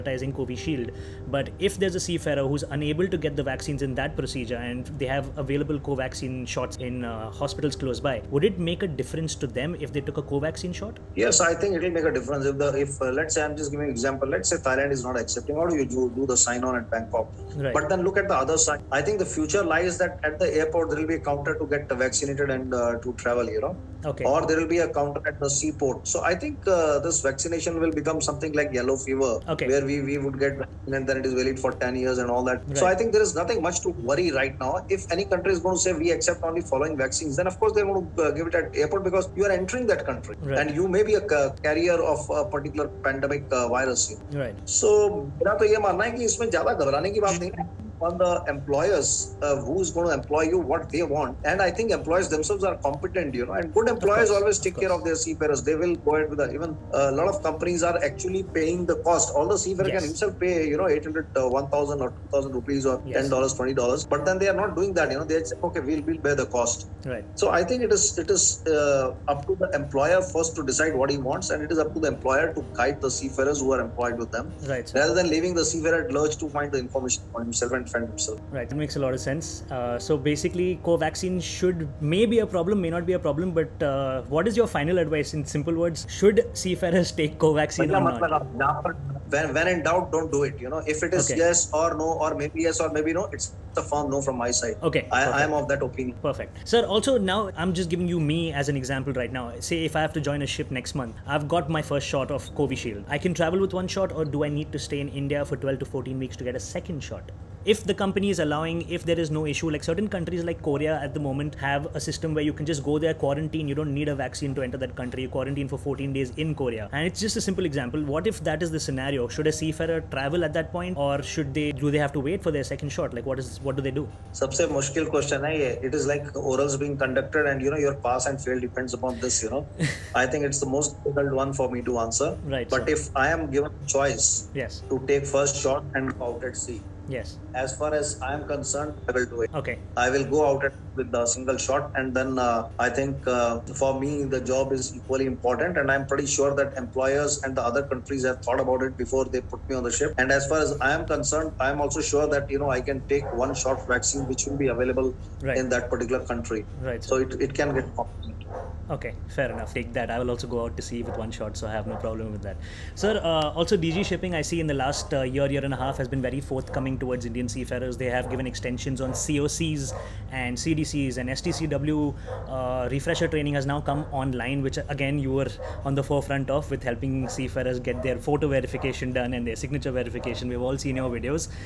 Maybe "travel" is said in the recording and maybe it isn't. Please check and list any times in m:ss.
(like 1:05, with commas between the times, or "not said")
0:23, 1:43, 2:00.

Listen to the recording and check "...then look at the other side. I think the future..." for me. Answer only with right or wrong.
right.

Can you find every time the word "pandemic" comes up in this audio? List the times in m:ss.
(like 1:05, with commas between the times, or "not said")
0:43.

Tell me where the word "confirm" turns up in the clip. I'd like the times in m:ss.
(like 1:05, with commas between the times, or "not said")
not said.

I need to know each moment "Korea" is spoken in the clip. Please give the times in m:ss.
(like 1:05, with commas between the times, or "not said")
1:50, 1:56.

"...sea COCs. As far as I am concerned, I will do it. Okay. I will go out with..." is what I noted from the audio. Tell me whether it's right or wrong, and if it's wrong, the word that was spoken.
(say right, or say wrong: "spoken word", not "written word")
wrong: "Yes", not "COCs".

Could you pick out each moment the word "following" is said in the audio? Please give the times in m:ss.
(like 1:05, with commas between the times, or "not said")
0:36.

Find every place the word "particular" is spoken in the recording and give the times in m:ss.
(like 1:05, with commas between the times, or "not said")
0:42, 2:35.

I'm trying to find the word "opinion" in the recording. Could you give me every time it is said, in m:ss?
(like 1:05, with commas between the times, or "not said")
1:35.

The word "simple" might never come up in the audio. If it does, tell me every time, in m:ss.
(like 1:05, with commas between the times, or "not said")
1:25, 1:57.